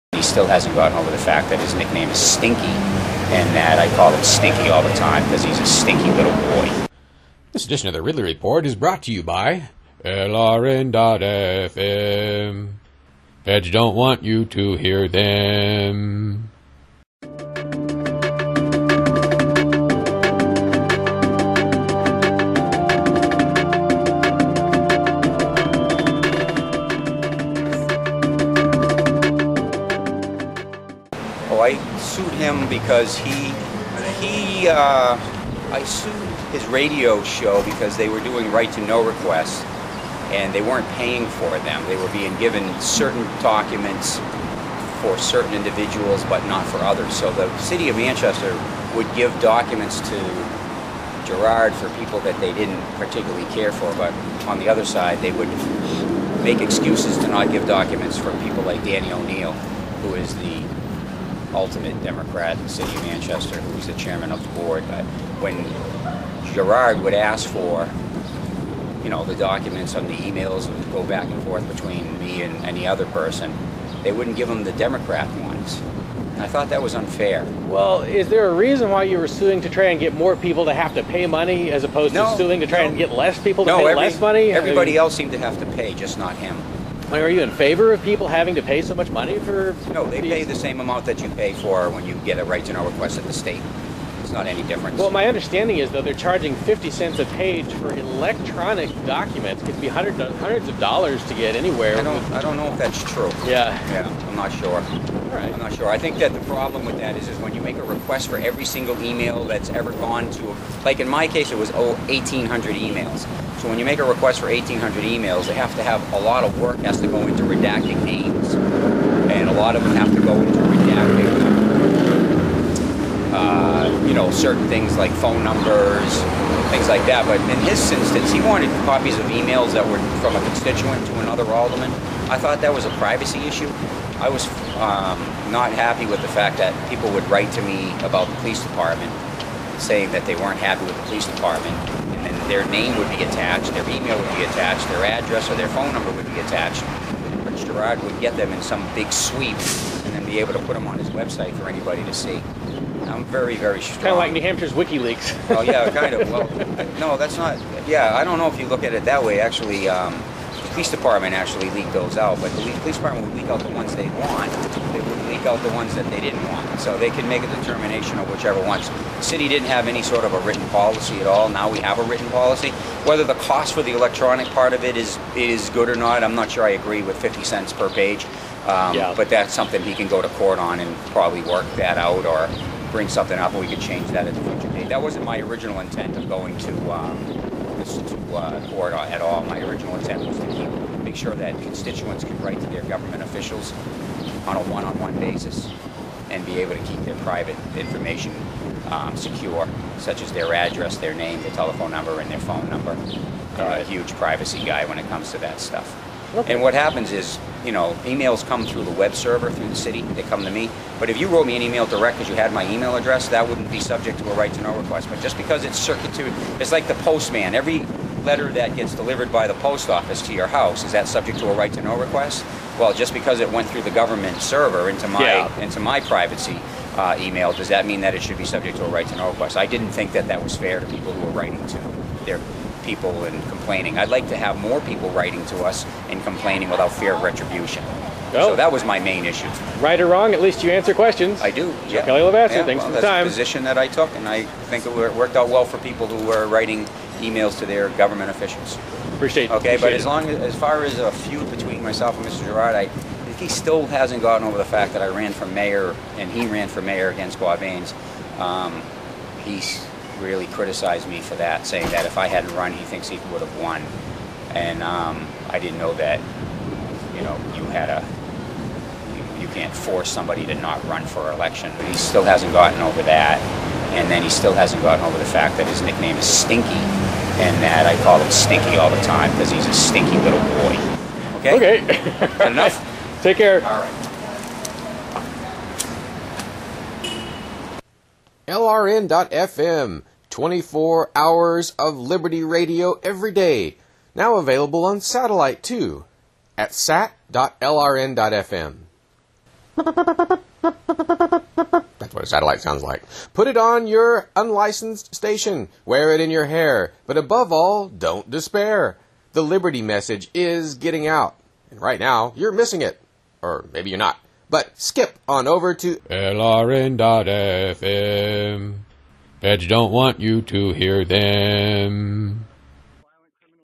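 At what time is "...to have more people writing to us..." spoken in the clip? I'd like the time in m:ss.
3:54.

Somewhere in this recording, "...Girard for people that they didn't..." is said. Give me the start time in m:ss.
0:51.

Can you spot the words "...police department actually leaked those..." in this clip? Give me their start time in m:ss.
2:40.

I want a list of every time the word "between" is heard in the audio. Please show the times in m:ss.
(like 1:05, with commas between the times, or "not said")
1:11, 4:11.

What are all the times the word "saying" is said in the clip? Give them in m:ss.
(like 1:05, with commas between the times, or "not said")
2:19, 4:21.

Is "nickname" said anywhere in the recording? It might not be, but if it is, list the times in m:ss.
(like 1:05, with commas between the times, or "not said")
0:01, 4:35.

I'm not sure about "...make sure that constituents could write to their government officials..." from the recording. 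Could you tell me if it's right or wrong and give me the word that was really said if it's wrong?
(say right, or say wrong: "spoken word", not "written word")
right.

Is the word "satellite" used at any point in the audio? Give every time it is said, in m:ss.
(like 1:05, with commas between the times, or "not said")
4:55, 5:02.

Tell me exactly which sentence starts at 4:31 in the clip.
But he still hasn't gotten over that.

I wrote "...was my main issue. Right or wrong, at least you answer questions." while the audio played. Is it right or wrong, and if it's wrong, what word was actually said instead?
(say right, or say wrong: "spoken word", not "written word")
right.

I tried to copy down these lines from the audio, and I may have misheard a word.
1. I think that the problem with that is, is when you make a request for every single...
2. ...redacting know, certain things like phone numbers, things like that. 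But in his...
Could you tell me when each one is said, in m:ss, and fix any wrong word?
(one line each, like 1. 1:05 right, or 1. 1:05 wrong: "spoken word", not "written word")
1. 1:45 right
2. 2:00 right.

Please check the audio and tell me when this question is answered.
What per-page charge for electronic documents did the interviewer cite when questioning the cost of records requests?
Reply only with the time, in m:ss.
1:36.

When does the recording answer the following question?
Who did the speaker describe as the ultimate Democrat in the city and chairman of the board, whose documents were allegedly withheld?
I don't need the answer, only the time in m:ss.
0:58.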